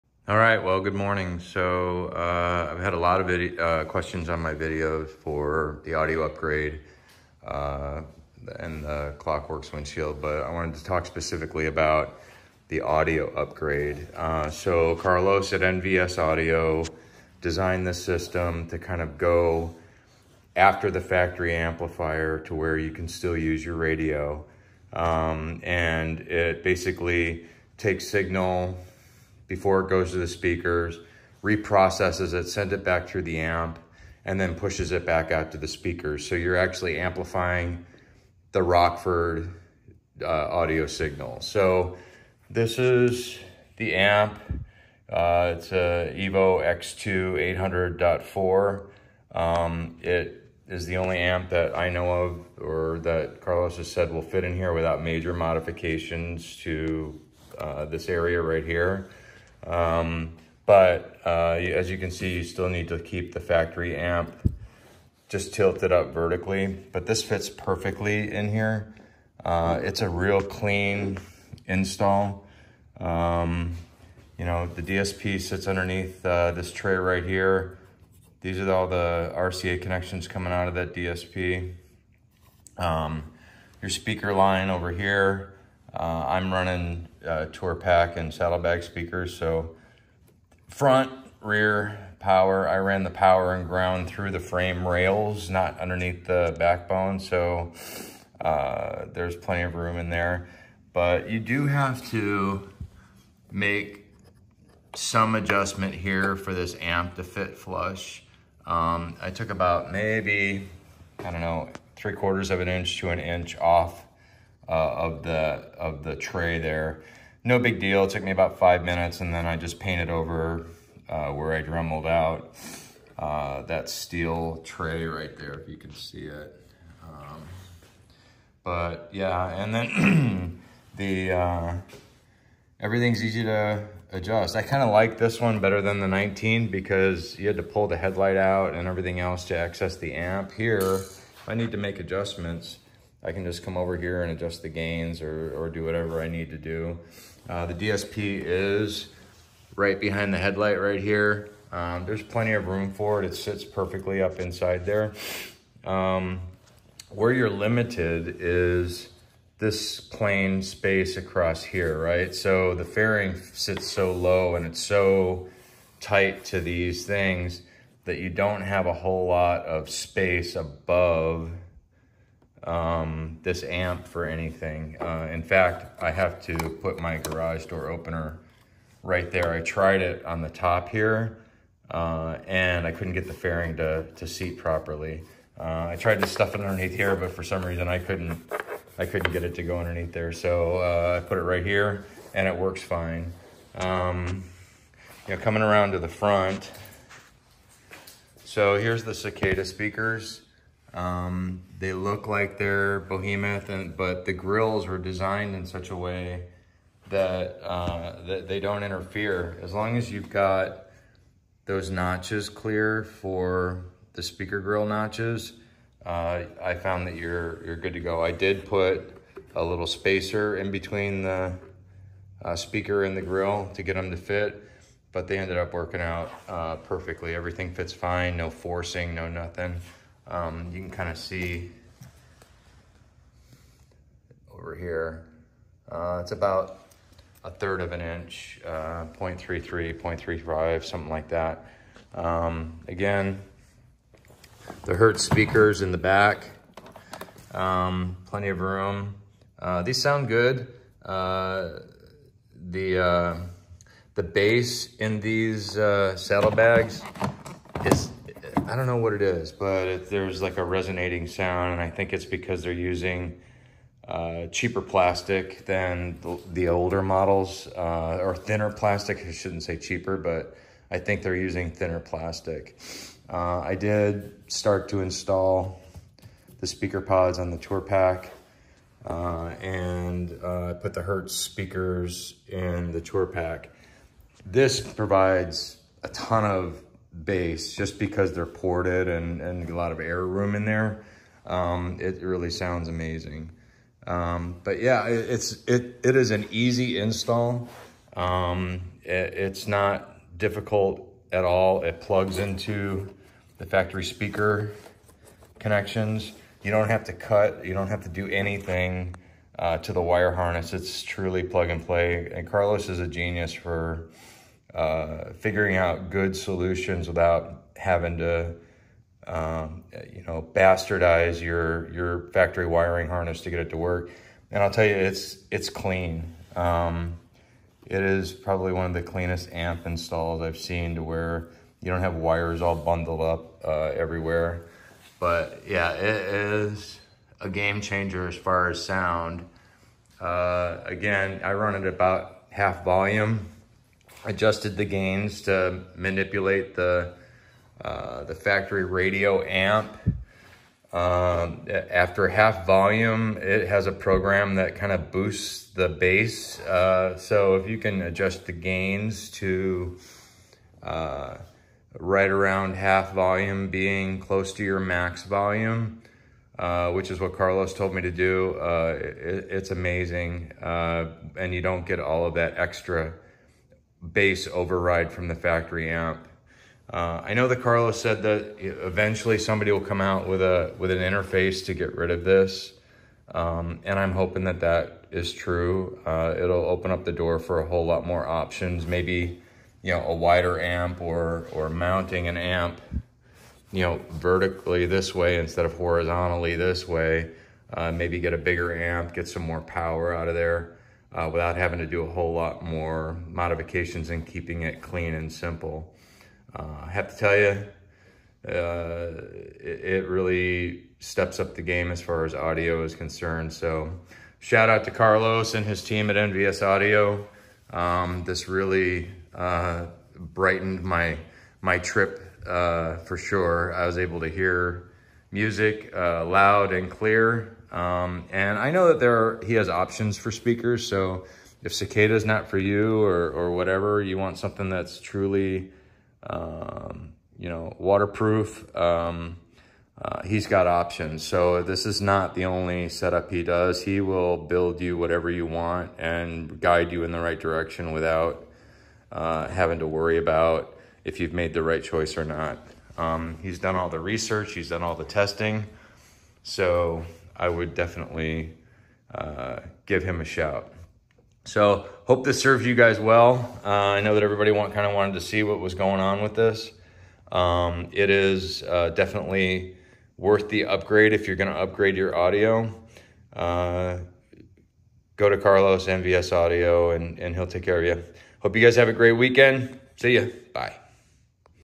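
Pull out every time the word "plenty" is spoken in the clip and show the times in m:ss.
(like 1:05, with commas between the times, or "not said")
1:39, 2:32, 4:08.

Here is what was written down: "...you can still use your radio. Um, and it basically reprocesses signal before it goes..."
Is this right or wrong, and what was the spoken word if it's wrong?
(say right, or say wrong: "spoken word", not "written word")
wrong: "takes", not "reprocesses".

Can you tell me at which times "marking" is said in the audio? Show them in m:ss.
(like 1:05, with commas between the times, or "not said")
not said.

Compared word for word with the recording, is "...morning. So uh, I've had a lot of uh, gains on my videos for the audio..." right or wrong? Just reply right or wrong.
wrong.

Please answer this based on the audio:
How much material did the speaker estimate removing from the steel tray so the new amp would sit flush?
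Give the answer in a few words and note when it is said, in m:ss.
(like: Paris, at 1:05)
three quarters of an inch to an inch, at 1:51.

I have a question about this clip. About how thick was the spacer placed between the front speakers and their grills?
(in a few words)
a third of an inch.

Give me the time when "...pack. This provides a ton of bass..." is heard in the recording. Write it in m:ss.
4:43.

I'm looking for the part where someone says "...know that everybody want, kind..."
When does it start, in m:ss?
7:44.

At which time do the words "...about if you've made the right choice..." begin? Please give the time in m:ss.
7:30.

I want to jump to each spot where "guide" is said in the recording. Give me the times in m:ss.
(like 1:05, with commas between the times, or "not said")
7:26.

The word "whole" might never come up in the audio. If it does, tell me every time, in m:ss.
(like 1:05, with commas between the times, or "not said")
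2:48, 6:27, 6:42.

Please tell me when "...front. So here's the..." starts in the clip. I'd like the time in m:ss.
3:16.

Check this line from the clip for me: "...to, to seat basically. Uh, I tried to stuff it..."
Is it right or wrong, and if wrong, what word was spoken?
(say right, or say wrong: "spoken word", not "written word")
wrong: "properly", not "basically".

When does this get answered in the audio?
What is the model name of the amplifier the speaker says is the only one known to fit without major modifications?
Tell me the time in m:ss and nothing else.
0:46.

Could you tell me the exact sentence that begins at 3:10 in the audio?
So uh, I put it right here and it works fine.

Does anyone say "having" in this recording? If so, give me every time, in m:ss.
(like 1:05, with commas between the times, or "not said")
5:17, 6:41, 7:29.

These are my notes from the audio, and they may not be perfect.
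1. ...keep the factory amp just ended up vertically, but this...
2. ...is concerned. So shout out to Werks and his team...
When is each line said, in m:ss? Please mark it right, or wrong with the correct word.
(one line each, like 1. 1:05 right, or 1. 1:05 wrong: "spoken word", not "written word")
1. 1:02 wrong: "tilted", not "ended"
2. 6:52 wrong: "Carlos", not "Werks".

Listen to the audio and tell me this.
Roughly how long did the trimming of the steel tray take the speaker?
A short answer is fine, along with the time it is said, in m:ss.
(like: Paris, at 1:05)
about five minutes, at 1:58.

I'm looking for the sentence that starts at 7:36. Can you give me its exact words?
So I would definitely uh, give him a shout.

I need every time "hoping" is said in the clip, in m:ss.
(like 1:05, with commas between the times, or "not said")
6:24.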